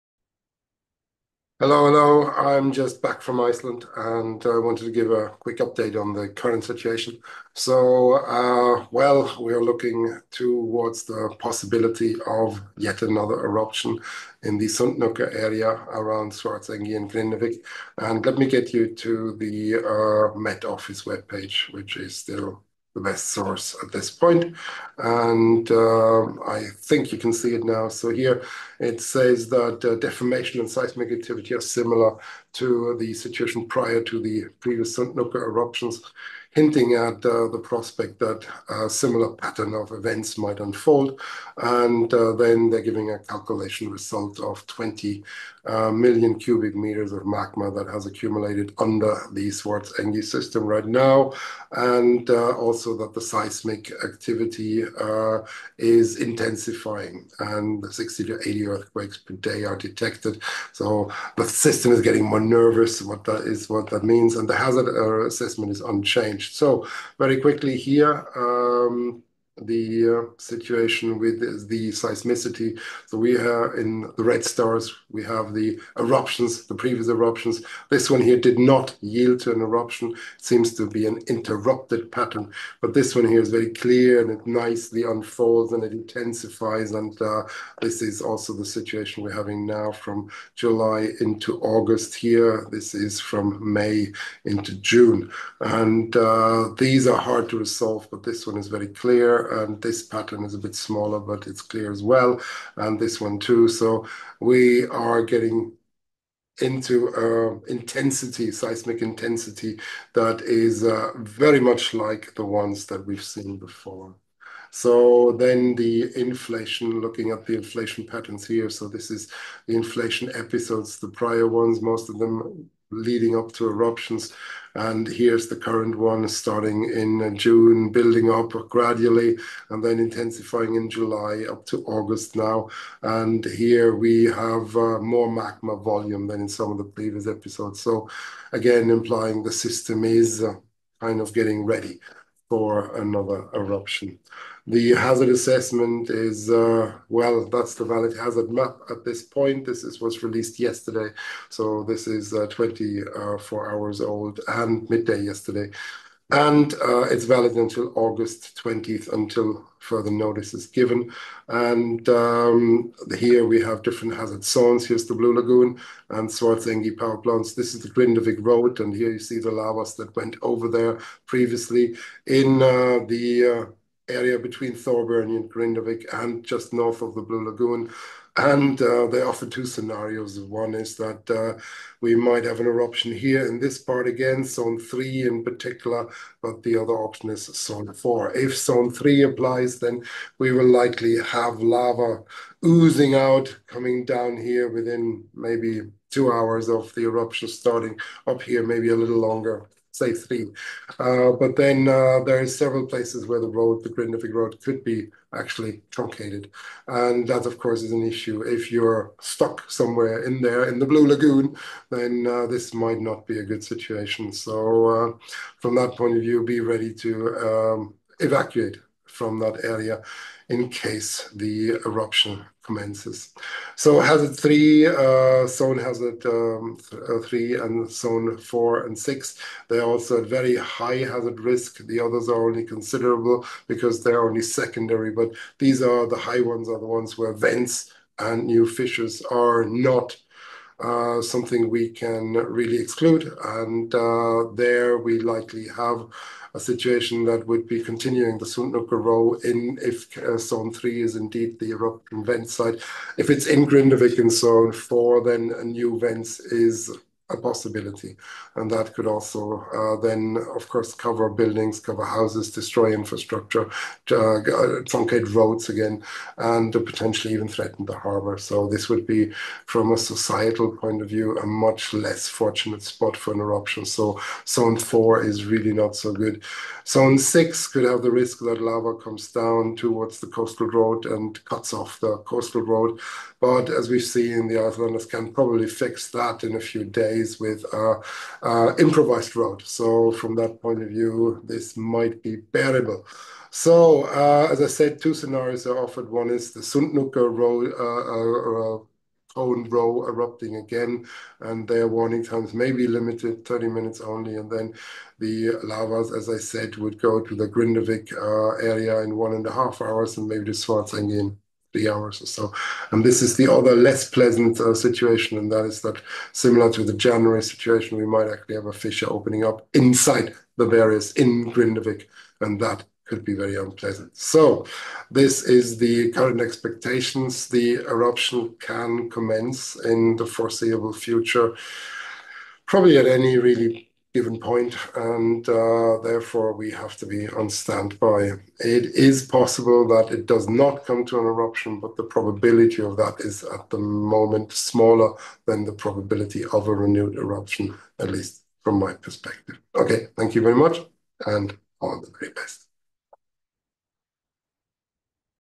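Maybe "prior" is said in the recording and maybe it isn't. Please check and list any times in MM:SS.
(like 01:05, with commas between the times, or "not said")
00:33, 02:01.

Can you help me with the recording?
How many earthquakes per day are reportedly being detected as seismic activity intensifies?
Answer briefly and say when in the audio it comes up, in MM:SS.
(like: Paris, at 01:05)
60-80, at 00:57.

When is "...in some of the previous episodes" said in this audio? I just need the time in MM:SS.
02:16.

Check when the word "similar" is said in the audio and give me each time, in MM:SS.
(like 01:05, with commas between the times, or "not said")
00:31, 00:38, 05:16.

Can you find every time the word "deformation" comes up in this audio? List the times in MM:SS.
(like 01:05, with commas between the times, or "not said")
00:29.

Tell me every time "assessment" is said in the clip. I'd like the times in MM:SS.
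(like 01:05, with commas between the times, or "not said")
01:05, 02:25.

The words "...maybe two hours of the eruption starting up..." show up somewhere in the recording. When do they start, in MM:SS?
03:15.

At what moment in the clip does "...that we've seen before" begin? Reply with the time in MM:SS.
01:52.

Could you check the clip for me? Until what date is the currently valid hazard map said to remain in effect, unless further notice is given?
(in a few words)
August 20th.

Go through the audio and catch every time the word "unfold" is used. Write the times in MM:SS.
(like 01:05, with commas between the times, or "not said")
00:40, 01:25.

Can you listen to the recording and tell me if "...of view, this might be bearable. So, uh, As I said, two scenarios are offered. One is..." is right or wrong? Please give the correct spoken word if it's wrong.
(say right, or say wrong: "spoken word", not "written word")
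right.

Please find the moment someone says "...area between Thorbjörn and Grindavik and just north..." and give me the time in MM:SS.
02:54.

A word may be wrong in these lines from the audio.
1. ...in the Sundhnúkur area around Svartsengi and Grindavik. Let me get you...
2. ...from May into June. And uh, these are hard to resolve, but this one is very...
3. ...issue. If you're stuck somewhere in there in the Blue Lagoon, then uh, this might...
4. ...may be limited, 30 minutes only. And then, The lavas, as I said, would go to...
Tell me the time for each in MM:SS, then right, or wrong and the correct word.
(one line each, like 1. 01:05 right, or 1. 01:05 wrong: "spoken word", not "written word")
1. 00:14 right
2. 01:33 right
3. 03:28 right
4. 05:02 right.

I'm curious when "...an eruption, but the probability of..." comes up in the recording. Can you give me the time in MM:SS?
05:41.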